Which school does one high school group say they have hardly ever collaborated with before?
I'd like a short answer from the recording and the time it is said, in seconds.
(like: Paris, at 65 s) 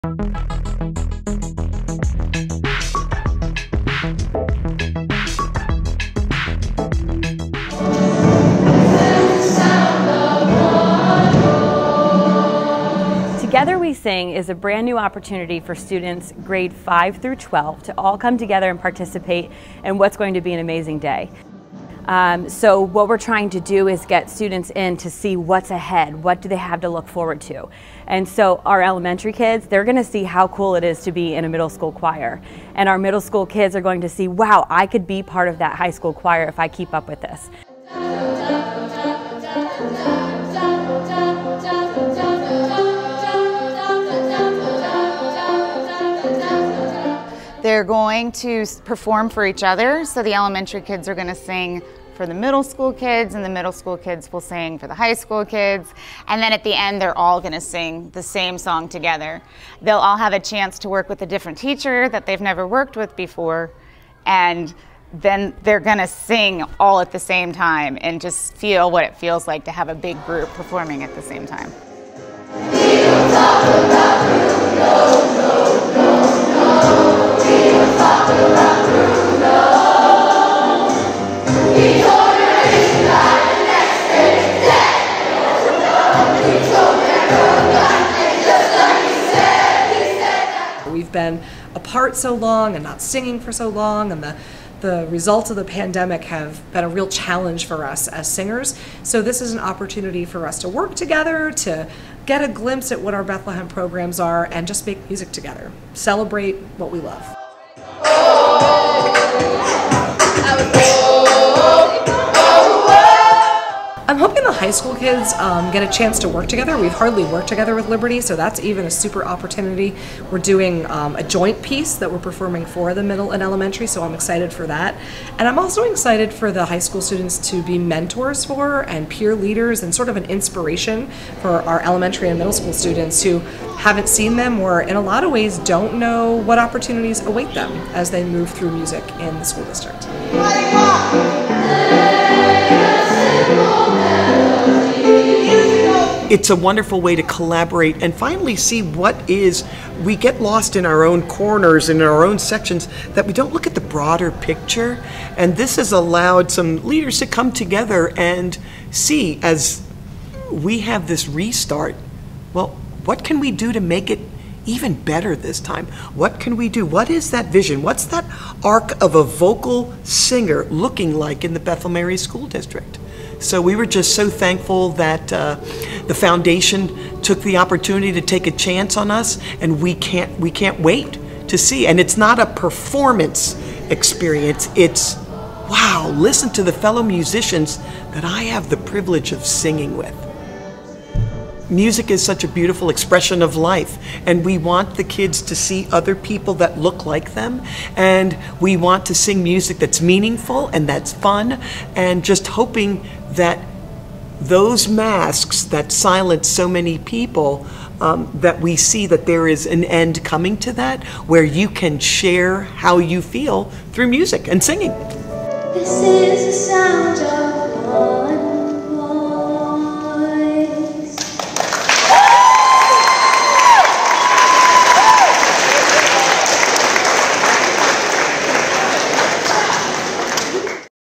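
Liberty, at 117 s.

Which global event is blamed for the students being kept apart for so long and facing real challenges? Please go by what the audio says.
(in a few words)
the pandemic.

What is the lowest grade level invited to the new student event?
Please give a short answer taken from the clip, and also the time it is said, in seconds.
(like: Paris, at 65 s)
5, at 16 s.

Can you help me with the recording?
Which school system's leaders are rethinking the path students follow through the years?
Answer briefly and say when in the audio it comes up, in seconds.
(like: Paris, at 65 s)
Bethlehem Area School District, at 171 s.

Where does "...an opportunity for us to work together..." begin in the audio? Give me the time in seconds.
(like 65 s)
99 s.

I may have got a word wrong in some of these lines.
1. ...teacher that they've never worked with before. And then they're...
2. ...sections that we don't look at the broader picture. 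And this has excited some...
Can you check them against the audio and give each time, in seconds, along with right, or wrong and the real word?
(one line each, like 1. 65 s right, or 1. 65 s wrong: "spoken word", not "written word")
1. 61 s right
2. 152 s wrong: "allowed", not "excited".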